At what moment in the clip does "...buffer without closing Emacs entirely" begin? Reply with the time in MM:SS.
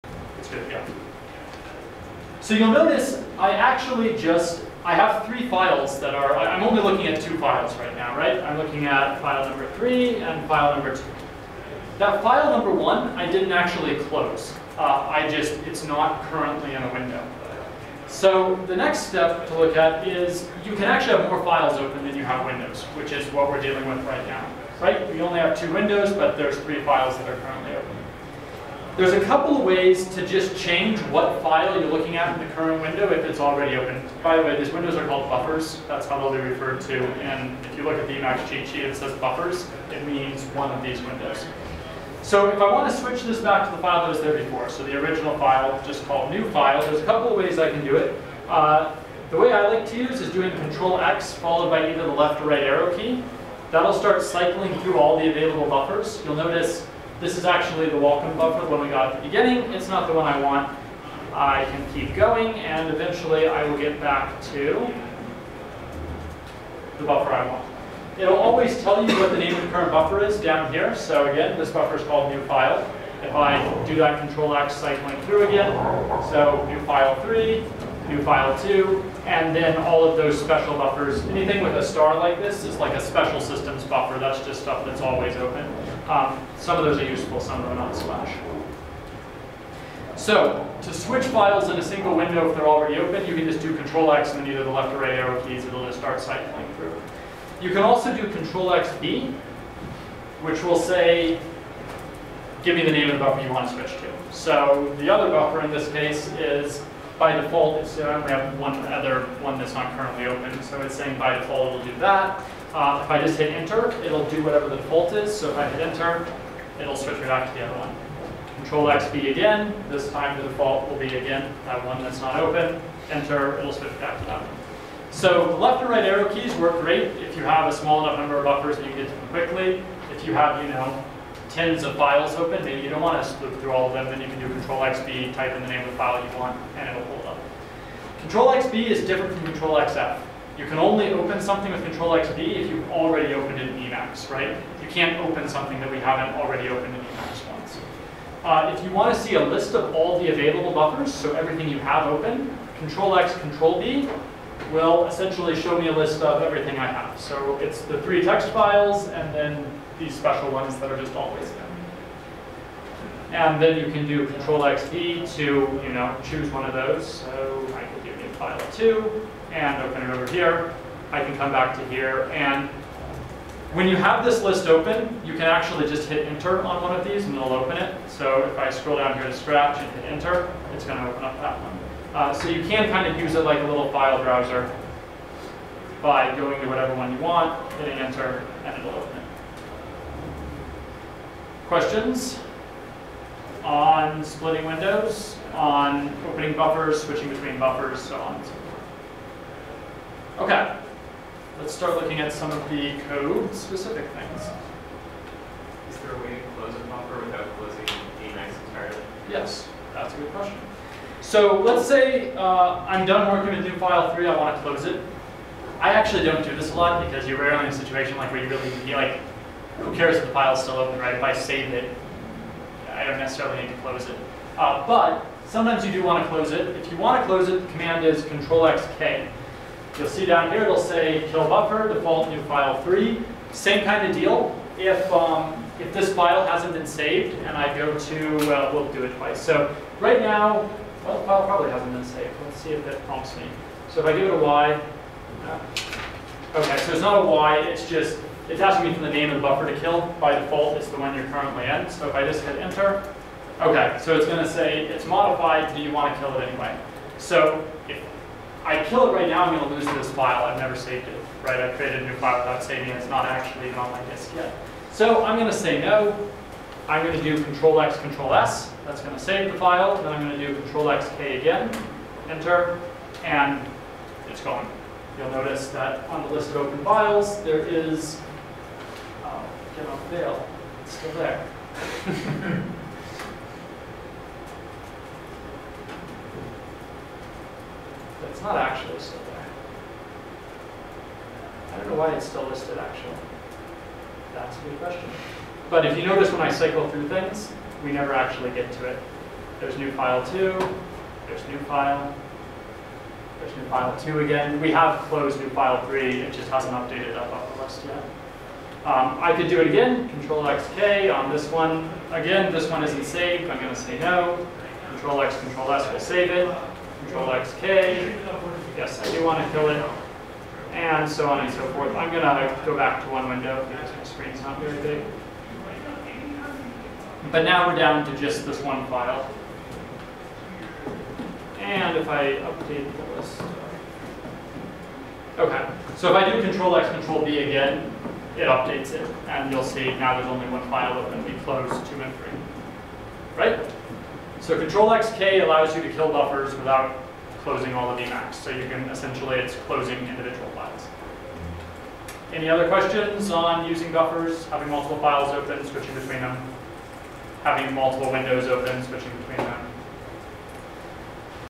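03:26.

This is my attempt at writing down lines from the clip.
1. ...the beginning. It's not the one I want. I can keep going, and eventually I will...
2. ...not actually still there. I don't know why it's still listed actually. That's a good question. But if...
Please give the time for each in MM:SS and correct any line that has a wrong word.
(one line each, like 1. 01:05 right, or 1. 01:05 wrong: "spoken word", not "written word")
1. 00:59 right
2. 04:48 right.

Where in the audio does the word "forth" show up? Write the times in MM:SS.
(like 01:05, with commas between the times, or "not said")
03:18, 05:21.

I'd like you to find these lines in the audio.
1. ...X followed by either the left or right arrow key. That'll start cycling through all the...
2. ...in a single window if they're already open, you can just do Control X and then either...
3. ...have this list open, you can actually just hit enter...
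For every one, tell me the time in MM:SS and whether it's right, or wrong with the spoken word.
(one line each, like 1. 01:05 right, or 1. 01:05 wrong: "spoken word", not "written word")
1. 00:50 right
2. 01:31 right
3. 02:53 right.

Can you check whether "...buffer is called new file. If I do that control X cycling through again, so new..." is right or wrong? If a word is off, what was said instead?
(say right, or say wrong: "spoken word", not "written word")
right.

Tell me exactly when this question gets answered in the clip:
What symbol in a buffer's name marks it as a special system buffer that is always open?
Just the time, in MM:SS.
01:21.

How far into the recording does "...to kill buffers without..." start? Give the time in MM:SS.
05:45.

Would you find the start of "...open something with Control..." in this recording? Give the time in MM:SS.
02:21.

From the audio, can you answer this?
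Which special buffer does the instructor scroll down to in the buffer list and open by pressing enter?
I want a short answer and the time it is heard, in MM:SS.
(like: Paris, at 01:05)
scratch, at 02:59.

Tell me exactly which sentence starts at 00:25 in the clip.
We only have two windows, but there's three files that are currently open.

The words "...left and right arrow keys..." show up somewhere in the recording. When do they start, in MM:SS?
02:05.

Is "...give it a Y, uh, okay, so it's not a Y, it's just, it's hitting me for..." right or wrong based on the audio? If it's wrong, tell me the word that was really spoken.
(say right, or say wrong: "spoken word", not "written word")
wrong: "asking", not "hitting".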